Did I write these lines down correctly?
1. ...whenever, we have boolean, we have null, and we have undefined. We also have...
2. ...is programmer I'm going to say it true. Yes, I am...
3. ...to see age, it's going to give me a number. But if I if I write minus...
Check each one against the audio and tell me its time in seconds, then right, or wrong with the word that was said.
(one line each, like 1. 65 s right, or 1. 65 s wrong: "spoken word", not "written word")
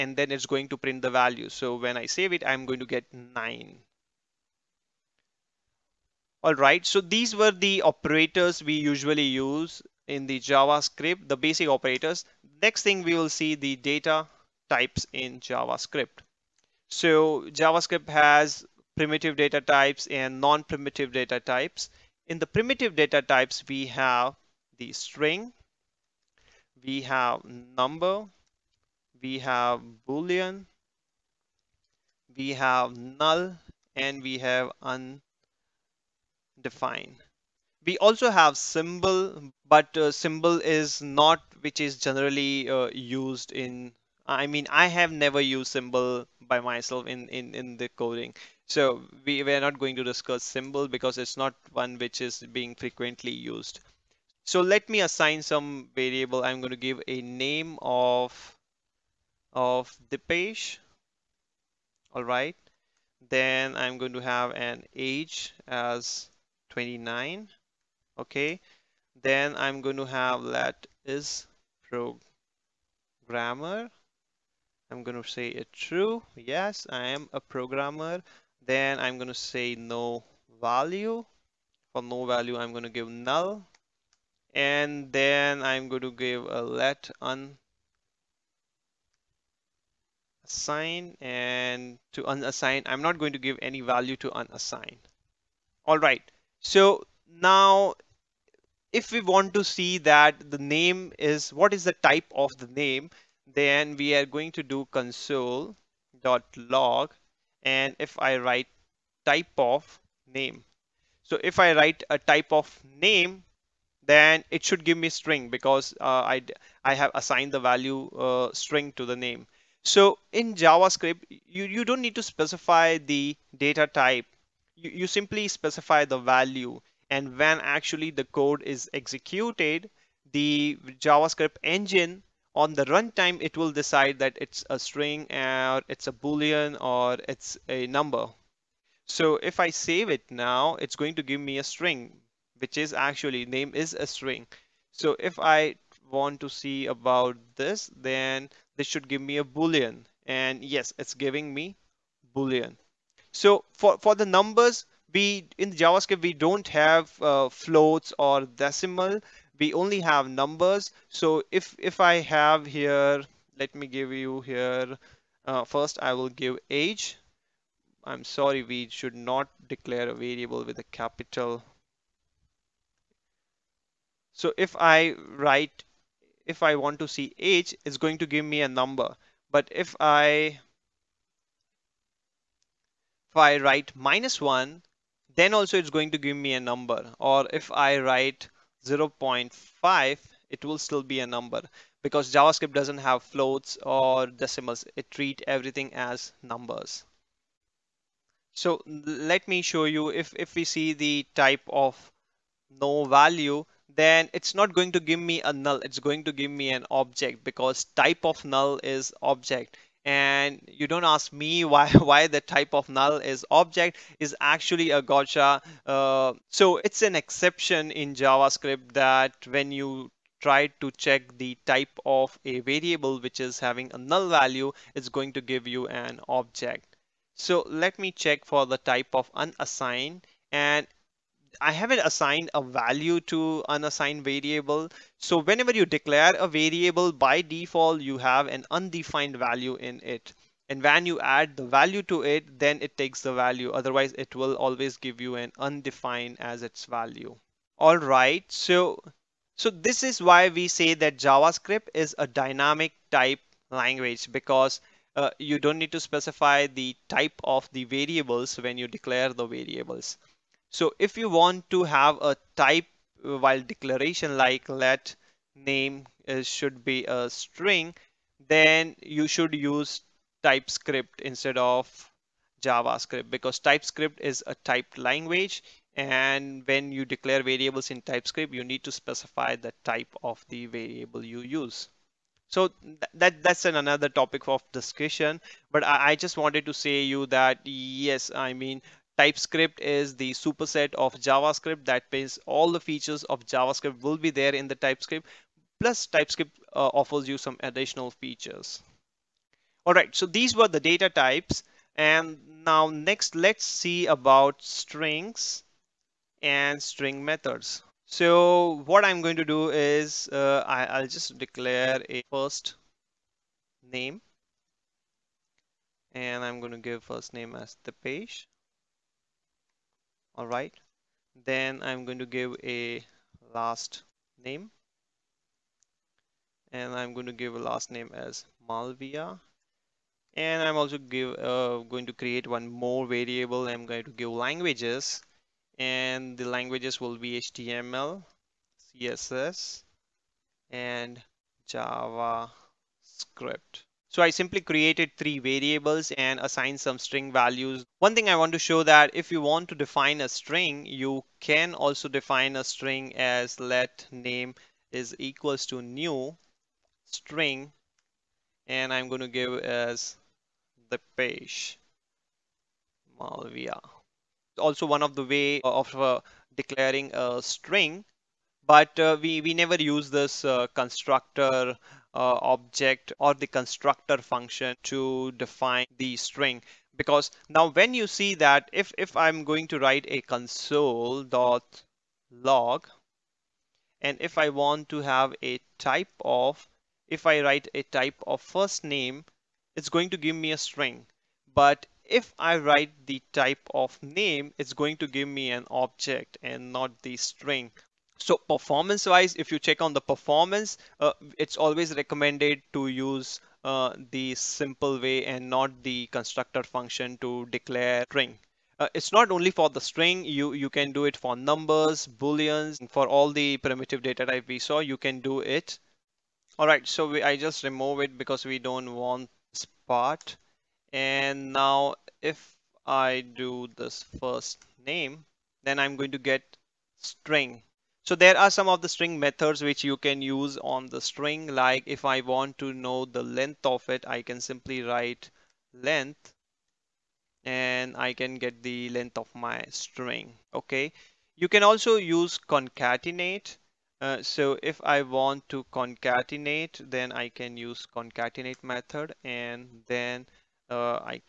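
1. 27 s wrong: "number", not "whenever"
2. 71 s right
3. 176 s right.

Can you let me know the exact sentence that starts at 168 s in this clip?
I'm sorry, we should not declare a variable with a capital.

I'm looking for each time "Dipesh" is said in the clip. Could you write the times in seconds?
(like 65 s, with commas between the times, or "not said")
60 s, 317 s.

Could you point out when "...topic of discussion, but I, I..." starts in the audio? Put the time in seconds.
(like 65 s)
284 s.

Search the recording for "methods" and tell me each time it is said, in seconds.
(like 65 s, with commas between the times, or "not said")
307 s, 429 s, 448 s.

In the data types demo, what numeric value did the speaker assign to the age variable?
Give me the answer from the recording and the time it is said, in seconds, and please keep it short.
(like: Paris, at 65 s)
29, at 66 s.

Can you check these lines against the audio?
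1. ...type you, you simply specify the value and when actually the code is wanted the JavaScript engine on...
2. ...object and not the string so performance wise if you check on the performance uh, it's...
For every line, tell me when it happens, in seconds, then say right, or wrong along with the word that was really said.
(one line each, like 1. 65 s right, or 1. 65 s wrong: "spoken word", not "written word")
1. 123 s wrong: "executed", not "wanted"
2. 395 s right.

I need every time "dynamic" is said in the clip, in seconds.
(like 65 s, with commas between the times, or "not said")
252 s.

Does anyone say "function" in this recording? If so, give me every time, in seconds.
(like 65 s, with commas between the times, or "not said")
374 s, 406 s.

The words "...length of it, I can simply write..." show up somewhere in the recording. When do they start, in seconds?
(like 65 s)
433 s.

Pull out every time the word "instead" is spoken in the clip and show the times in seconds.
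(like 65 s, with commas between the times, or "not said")
271 s.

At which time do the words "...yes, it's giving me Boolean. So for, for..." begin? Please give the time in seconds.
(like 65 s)
150 s.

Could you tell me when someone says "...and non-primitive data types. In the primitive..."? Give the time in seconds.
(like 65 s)
20 s.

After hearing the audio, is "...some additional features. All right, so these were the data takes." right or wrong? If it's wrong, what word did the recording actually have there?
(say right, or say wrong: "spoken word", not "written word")
wrong: "types", not "takes".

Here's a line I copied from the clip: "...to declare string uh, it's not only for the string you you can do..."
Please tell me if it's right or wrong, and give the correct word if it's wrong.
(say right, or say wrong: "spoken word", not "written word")
right.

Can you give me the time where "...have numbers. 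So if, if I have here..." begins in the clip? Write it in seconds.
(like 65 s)
160 s.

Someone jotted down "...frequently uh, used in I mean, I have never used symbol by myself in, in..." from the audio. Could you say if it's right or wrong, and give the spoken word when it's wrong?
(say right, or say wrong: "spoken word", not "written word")
wrong: "generally", not "frequently".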